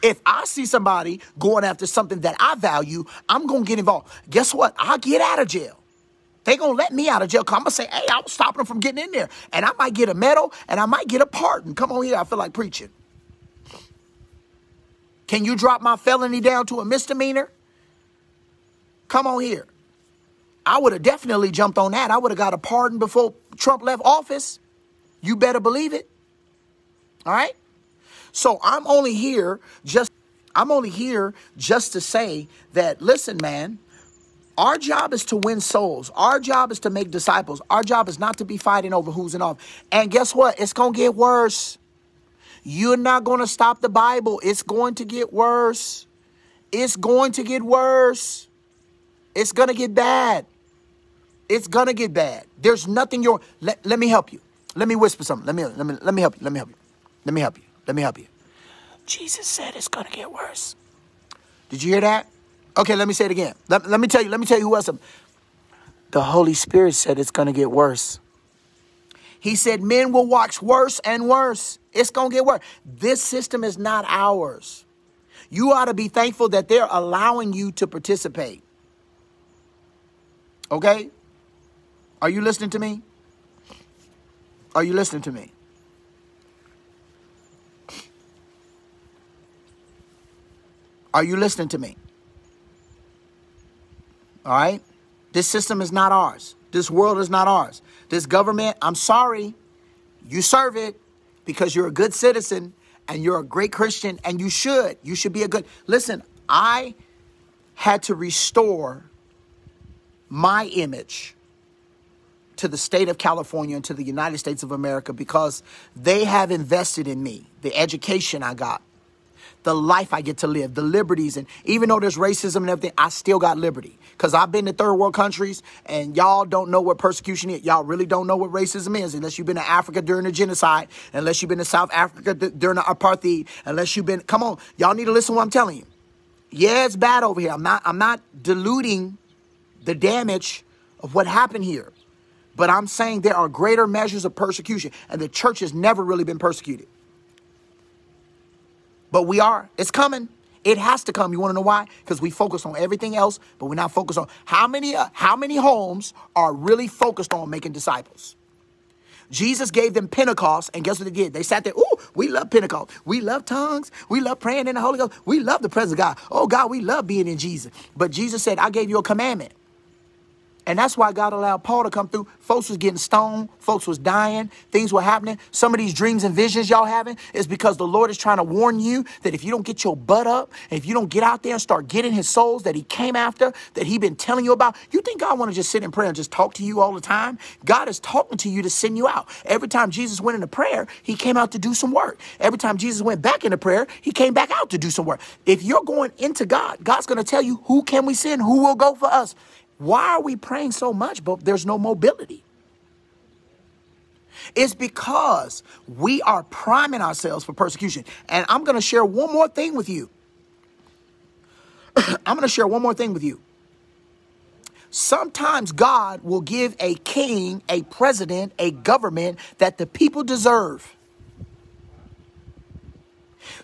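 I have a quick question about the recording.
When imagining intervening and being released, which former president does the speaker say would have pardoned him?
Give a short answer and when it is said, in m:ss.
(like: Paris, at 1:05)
Trump, at 0:23.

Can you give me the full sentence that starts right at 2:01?
And even though there's racism and everything, I still got liberty.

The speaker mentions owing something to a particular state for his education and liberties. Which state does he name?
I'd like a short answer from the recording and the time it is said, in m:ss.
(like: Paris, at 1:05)
California, at 1:53.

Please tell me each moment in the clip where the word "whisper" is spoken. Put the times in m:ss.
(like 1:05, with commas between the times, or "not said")
0:54.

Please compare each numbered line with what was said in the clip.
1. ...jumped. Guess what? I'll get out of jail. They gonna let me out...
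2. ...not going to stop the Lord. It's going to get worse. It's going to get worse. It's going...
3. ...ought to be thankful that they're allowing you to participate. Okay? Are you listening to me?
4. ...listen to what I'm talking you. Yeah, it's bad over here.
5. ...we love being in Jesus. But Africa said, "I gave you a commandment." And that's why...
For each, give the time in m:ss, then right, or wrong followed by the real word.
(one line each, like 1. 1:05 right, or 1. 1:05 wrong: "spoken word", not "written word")
1. 0:03 wrong: "involved", not "jumped"
2. 0:42 wrong: "Bible", not "Lord"
3. 1:15 right
4. 2:15 wrong: "telling", not "talking"
5. 2:46 wrong: "Jesus", not "Africa".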